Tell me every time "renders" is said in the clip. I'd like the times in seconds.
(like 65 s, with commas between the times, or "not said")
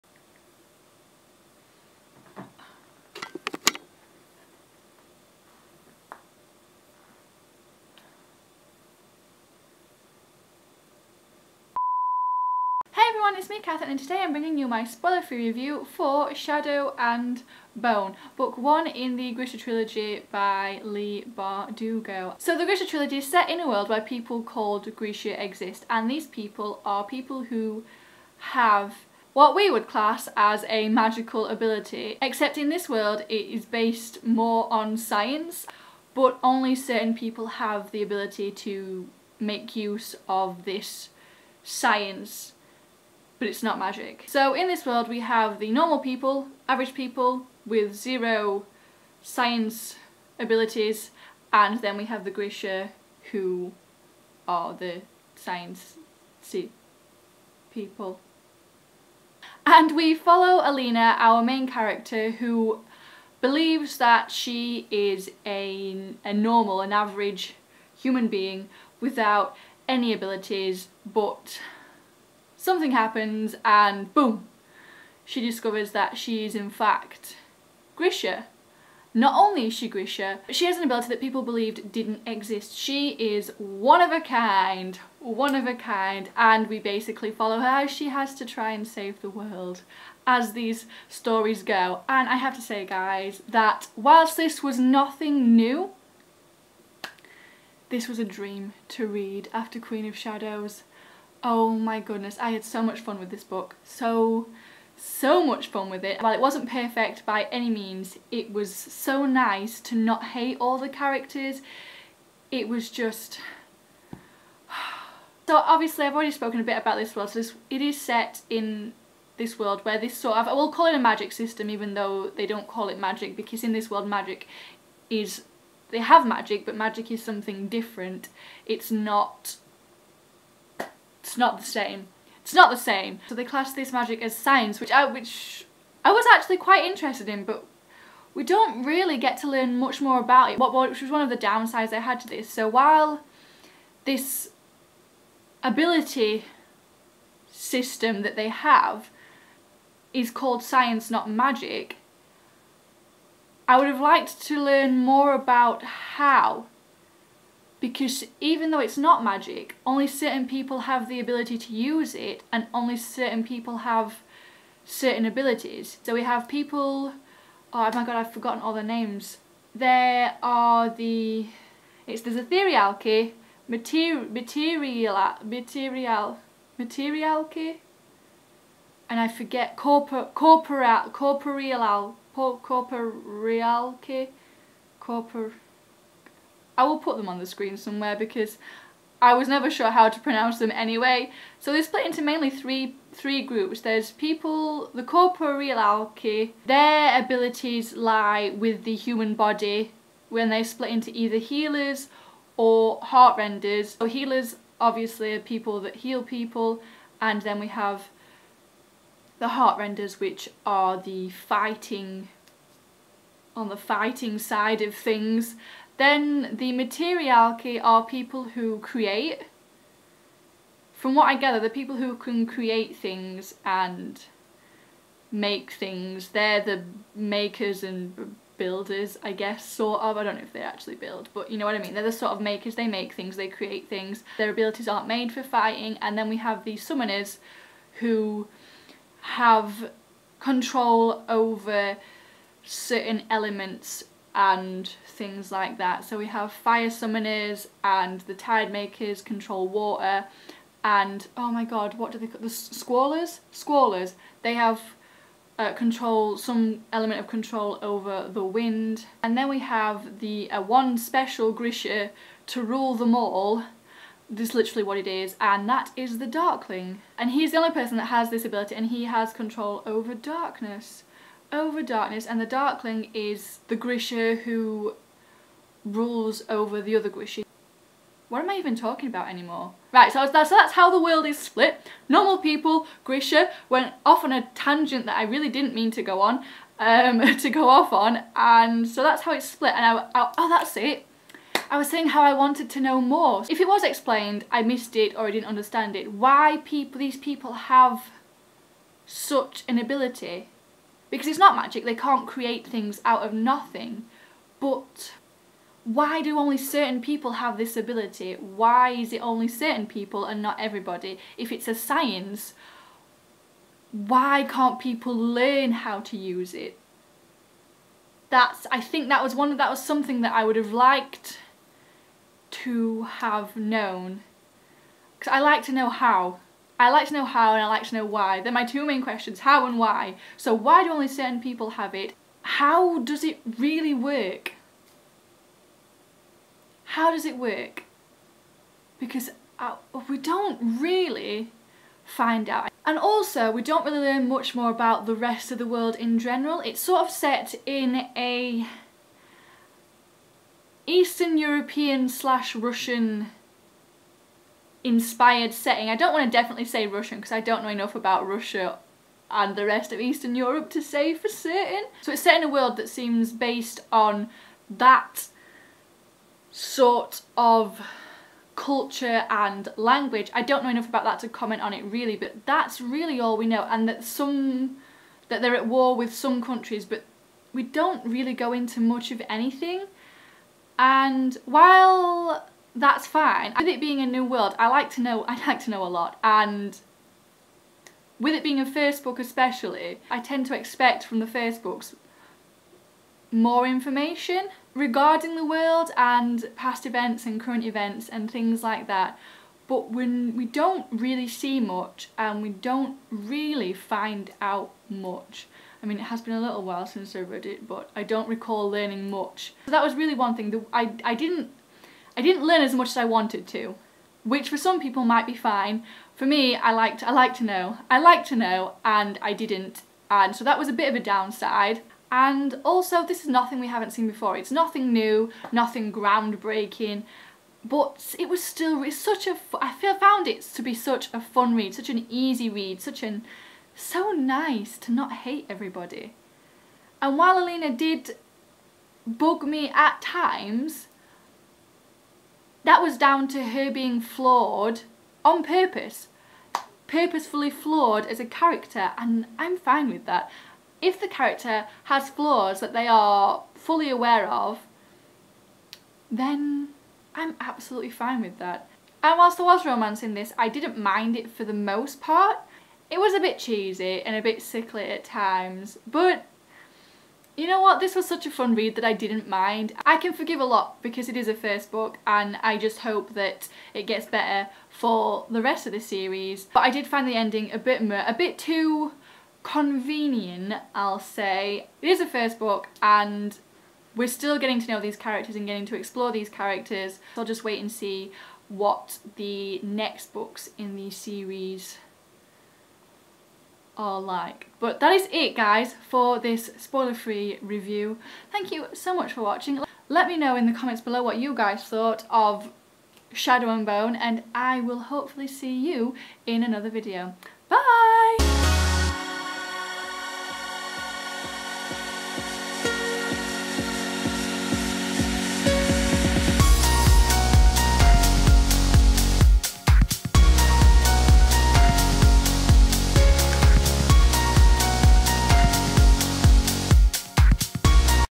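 203 s, 209 s.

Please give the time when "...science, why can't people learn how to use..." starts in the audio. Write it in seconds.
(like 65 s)
311 s.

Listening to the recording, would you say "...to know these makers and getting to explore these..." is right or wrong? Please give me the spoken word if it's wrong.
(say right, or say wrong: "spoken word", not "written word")
wrong: "characters", not "makers".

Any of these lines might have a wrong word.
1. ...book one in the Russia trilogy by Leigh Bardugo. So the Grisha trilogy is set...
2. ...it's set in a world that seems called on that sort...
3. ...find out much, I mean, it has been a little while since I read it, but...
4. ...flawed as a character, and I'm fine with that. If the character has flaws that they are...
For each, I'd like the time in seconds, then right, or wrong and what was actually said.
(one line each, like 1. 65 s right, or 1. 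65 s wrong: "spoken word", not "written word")
1. 18 s wrong: "Grisha", not "Russia"
2. 362 s wrong: "based", not "called"
3. 403 s right
4. 447 s right.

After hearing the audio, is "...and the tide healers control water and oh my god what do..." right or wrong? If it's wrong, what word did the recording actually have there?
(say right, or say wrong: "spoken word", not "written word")
wrong: "makers", not "healers".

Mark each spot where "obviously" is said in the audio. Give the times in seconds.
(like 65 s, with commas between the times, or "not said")
115 s, 204 s.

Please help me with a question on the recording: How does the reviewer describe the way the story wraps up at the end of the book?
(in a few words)
too convenient.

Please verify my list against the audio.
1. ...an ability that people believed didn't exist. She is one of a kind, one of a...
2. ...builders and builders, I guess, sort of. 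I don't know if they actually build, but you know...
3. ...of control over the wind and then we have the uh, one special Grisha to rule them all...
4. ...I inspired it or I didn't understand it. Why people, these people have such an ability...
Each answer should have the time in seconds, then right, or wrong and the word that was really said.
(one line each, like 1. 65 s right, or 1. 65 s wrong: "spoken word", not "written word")
1. 80 s right
2. 227 s wrong: "makers", not "builders"
3. 257 s right
4. 294 s wrong: "missed", not "inspired".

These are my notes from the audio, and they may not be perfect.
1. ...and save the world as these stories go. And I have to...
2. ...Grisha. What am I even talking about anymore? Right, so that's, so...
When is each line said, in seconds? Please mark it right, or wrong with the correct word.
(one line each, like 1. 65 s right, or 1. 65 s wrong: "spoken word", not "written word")
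1. 88 s right
2. 277 s right.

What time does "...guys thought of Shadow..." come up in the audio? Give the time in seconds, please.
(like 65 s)
501 s.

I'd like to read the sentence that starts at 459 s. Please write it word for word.
And whilst there was romance in this, I didn't mind it for the most part.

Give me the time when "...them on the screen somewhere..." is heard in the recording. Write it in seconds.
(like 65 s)
187 s.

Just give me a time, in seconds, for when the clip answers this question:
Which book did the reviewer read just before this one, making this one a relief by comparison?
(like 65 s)
99 s.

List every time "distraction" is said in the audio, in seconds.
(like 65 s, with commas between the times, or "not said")
not said.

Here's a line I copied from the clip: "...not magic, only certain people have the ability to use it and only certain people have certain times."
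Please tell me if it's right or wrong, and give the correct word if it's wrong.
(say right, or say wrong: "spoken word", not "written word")
wrong: "abilities", not "times".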